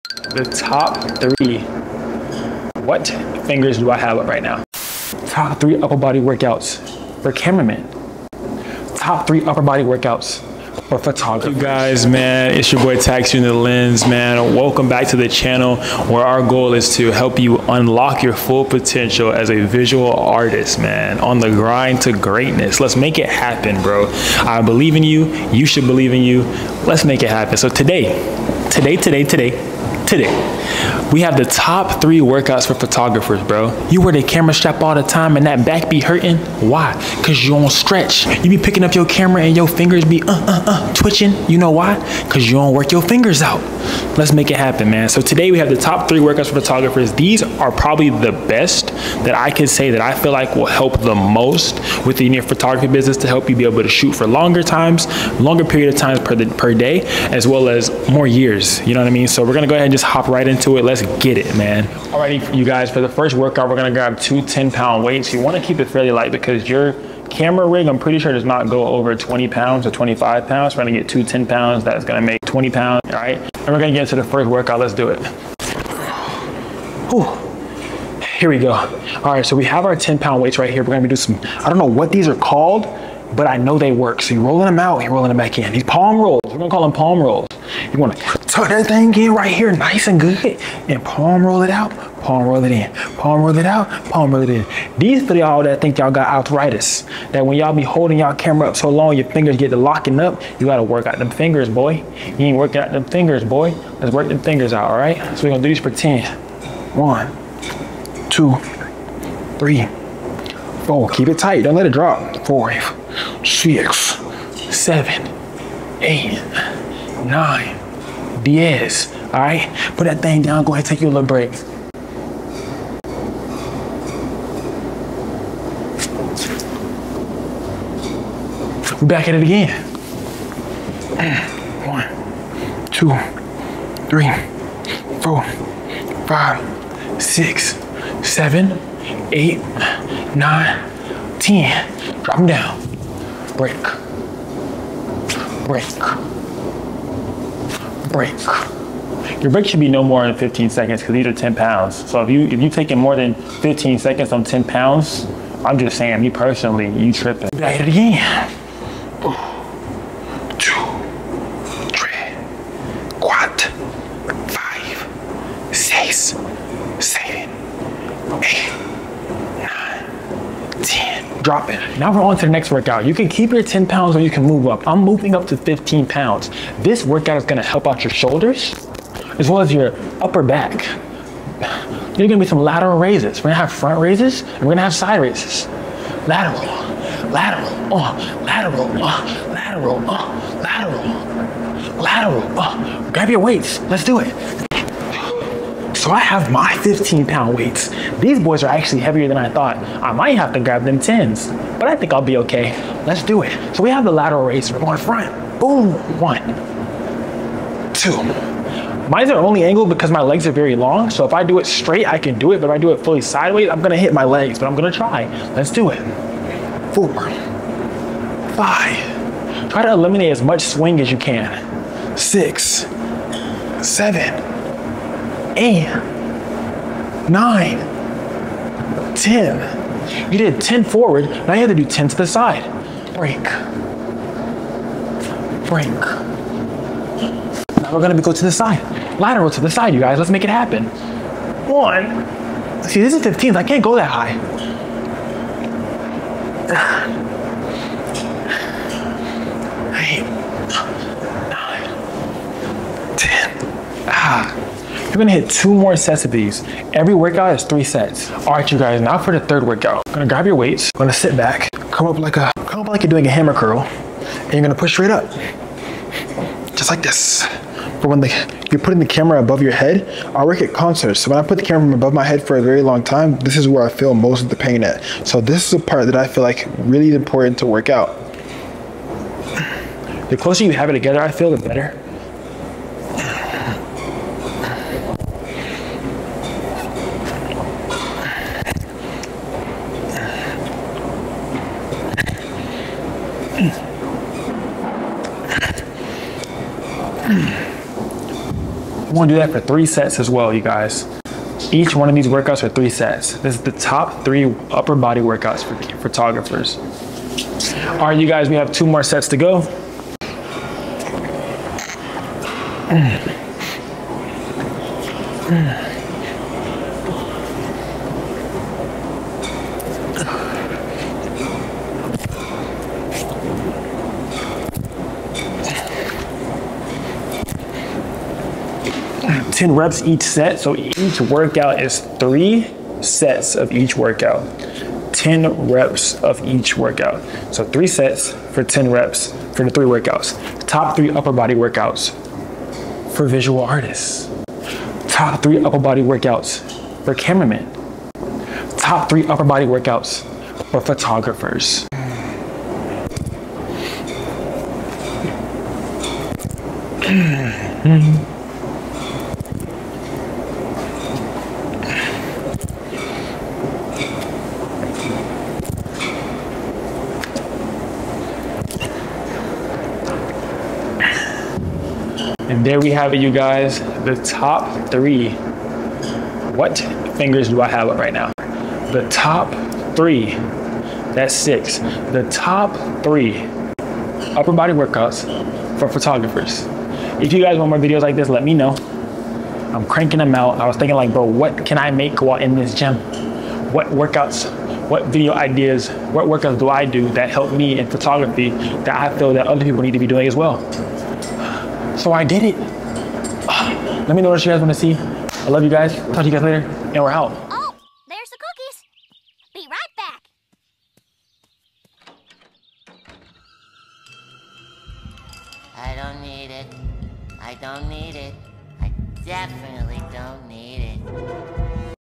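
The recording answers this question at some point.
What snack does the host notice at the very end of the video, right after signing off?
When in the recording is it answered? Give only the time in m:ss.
6:48.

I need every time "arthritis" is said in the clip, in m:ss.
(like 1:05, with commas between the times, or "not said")
1:36.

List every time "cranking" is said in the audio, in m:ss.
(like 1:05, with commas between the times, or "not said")
6:29.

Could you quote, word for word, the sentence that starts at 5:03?
This is the top three upper body workouts for photographers.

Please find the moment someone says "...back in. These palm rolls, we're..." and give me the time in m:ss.
1:25.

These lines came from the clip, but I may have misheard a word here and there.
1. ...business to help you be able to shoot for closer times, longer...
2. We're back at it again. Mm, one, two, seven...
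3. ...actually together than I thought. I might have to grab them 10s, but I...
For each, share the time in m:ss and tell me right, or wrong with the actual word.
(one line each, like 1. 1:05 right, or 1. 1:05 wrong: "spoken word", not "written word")
1. 0:52 wrong: "longer", not "closer"
2. 2:09 wrong: "three", not "seven"
3. 3:18 wrong: "heavier", not "together".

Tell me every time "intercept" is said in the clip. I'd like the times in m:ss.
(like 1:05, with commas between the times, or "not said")
not said.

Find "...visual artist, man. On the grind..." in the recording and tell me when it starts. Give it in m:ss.
0:19.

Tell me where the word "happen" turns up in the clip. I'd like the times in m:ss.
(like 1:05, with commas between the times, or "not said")
0:23, 0:27, 0:44, 4:00.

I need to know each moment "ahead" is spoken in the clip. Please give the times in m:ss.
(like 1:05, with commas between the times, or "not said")
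0:59, 2:00.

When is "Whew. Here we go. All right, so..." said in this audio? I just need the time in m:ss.
1:17.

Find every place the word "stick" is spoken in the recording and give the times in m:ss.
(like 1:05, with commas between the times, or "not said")
not said.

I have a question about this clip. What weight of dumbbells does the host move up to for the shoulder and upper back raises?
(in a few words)
15 pounds.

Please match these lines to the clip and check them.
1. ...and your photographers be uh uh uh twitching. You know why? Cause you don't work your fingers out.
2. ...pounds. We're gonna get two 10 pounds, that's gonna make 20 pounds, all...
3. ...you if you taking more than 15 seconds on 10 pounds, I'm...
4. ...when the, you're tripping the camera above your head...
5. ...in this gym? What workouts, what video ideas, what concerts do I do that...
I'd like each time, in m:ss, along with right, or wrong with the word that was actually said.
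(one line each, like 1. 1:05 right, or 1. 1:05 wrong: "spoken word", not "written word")
1. 0:39 wrong: "fingers", not "photographers"
2. 1:10 right
3. 2:32 right
4. 4:28 wrong: "putting", not "tripping"
5. 6:32 wrong: "workouts", not "concerts".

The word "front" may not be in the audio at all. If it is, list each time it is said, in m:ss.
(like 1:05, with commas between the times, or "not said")
3:03, 3:24.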